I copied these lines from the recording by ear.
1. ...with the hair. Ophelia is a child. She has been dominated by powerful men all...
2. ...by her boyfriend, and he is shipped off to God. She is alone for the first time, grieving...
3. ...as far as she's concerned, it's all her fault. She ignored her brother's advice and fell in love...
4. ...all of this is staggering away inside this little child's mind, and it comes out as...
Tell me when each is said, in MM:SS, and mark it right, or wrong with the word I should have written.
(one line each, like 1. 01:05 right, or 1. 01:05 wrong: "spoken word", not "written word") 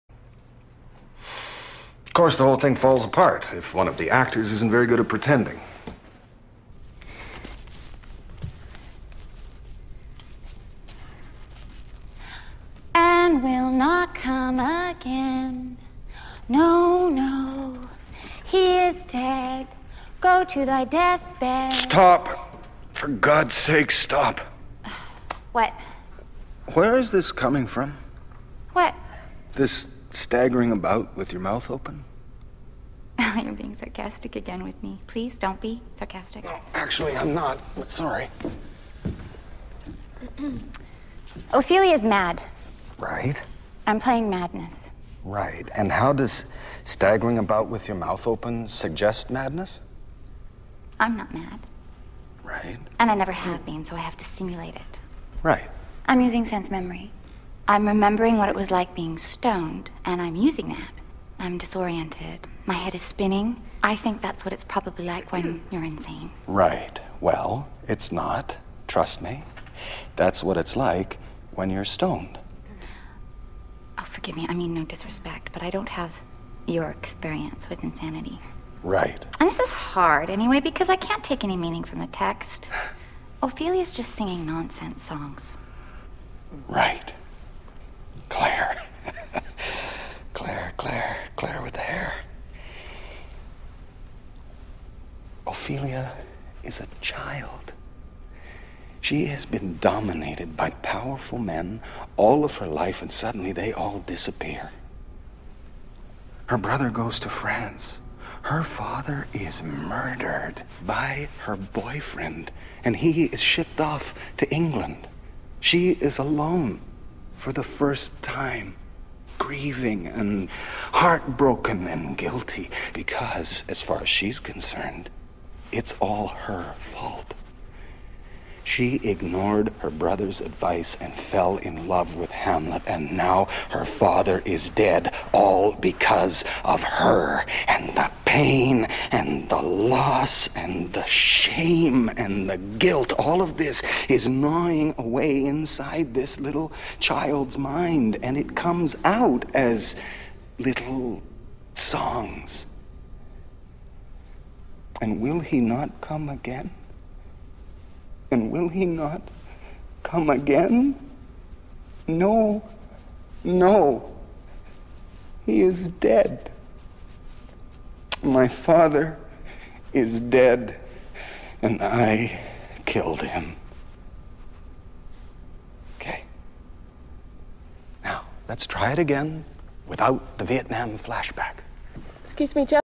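1. 01:31 right
2. 01:50 wrong: "England", not "God"
3. 02:03 right
4. 02:23 wrong: "gnawing", not "staggering".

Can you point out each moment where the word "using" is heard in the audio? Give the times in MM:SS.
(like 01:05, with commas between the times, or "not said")
00:56, 01:00.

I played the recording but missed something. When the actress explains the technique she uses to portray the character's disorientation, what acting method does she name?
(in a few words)
Sense memory.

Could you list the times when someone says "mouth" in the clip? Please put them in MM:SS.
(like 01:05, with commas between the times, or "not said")
00:31, 00:47.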